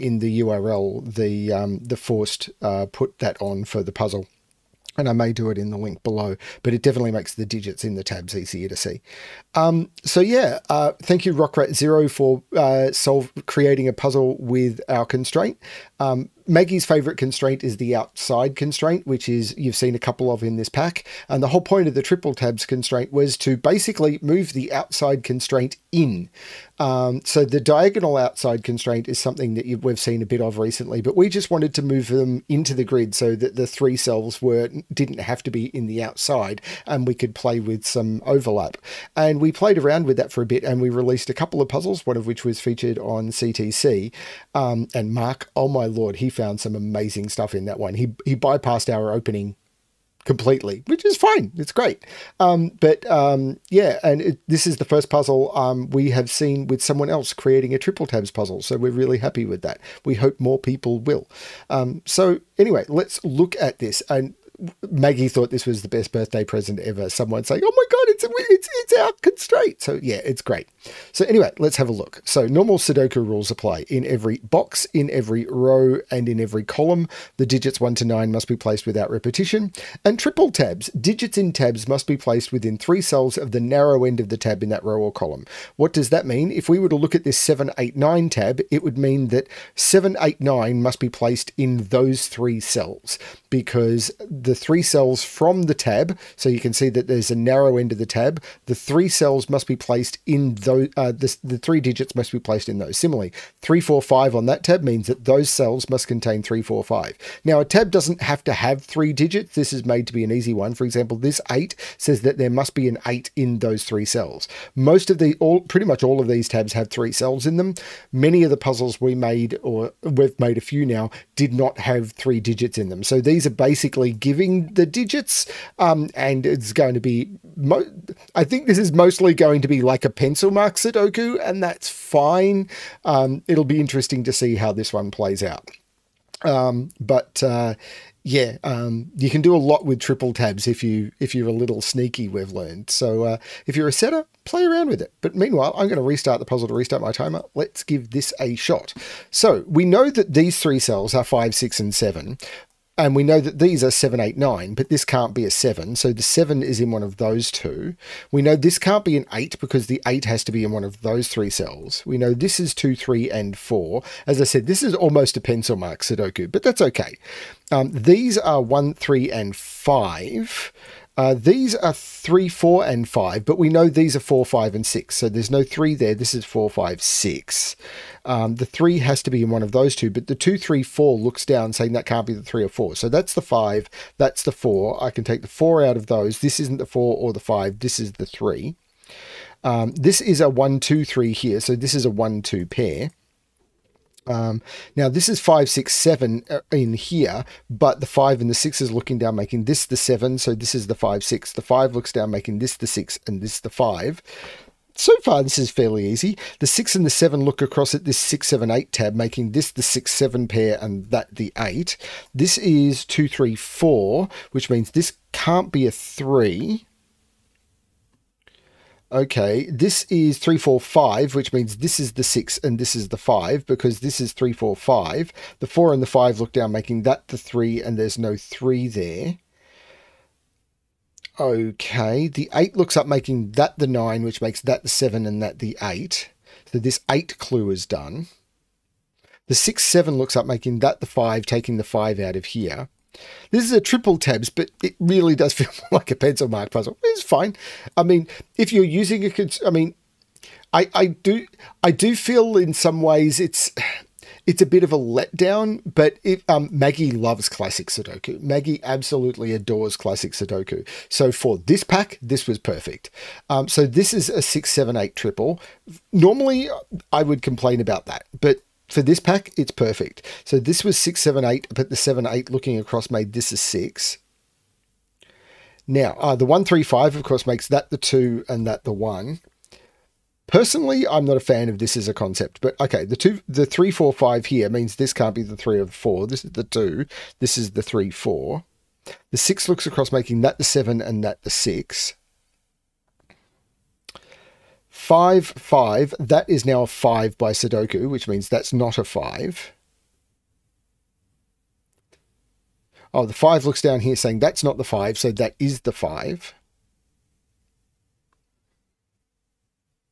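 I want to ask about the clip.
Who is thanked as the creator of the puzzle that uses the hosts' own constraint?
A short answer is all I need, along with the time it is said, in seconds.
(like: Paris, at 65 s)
Rockrat Zero, at 11 s.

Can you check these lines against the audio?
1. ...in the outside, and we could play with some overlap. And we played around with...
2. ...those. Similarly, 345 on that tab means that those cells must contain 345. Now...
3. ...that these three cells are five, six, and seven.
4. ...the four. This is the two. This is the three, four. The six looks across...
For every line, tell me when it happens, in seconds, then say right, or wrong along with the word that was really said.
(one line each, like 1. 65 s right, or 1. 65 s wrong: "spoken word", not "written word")
1. 35 s right
2. 102 s right
3. 150 s right
4. 285 s right.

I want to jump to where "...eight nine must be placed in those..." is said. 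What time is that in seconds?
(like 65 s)
90 s.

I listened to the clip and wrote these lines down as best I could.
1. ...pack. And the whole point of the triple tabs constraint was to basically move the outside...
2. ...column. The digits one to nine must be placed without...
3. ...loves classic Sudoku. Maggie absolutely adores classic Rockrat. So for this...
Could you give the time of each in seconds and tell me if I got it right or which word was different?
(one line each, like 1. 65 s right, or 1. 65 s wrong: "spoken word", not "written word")
1. 20 s right
2. 76 s right
3. 257 s wrong: "Sudoku", not "Rockrat".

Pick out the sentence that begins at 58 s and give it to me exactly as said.
So we're really happy with that.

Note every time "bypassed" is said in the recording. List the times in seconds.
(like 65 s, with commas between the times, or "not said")
48 s.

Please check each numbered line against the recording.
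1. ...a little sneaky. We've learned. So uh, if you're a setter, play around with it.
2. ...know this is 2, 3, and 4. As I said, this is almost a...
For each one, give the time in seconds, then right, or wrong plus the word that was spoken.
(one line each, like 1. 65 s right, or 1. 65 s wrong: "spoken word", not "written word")
1. 141 s right
2. 162 s right.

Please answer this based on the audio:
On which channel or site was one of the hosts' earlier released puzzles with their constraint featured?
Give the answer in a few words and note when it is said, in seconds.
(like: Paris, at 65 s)
CTC, at 43 s.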